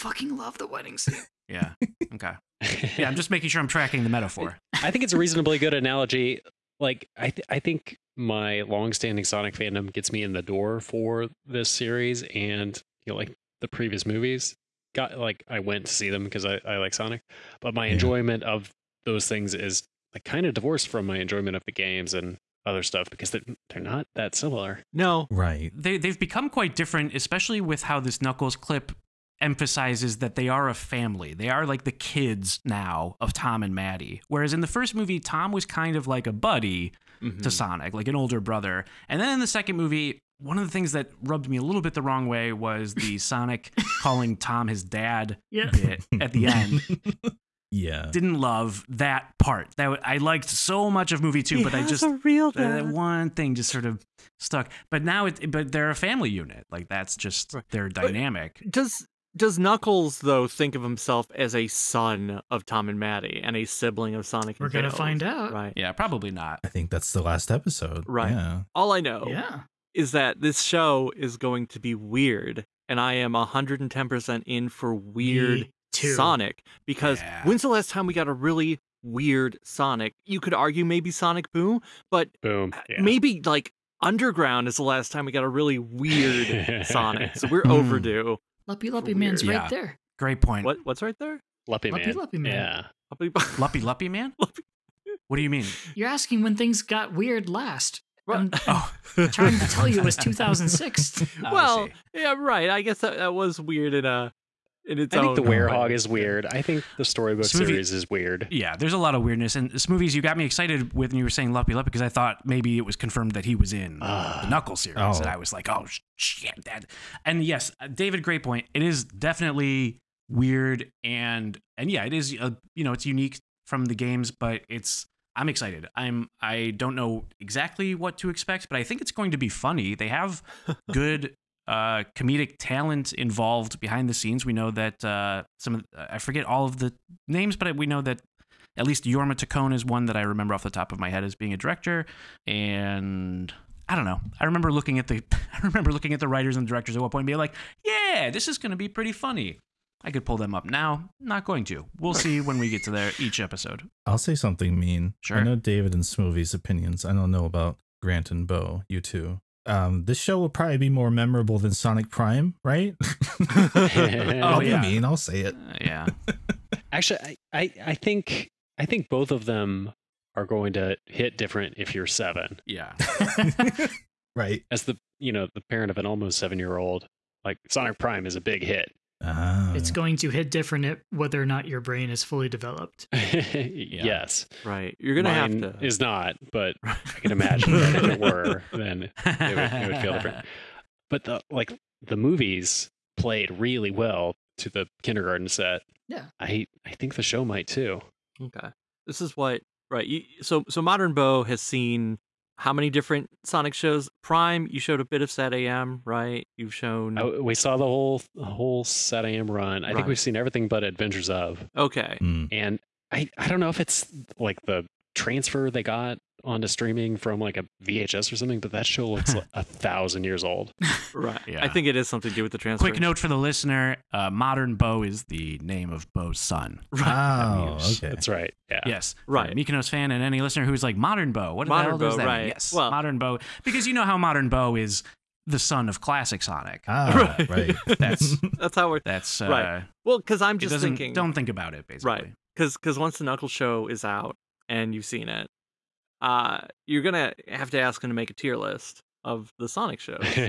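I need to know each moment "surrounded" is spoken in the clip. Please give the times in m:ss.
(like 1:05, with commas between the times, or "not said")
not said.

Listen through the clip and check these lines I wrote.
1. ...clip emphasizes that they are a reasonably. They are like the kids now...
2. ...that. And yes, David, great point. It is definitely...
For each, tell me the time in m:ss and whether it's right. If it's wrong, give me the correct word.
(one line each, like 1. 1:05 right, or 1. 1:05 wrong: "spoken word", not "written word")
1. 0:28 wrong: "family", not "reasonably"
2. 1:56 right.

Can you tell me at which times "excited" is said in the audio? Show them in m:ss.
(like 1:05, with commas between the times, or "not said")
1:50, 2:05.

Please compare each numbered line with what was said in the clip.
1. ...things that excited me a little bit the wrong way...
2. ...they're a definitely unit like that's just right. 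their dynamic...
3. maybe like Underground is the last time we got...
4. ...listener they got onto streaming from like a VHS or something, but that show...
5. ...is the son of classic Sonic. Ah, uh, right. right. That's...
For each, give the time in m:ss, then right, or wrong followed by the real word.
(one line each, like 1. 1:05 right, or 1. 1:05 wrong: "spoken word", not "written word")
1. 0:40 wrong: "rubbed", not "excited"
2. 0:55 wrong: "family", not "definitely"
3. 1:23 right
4. 3:35 wrong: "transfer", not "listener"
5. 3:54 right.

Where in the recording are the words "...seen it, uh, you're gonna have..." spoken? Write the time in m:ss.
4:05.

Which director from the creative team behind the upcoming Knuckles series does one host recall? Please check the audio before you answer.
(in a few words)
Jorma Taccone.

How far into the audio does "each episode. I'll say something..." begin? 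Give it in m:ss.
2:33.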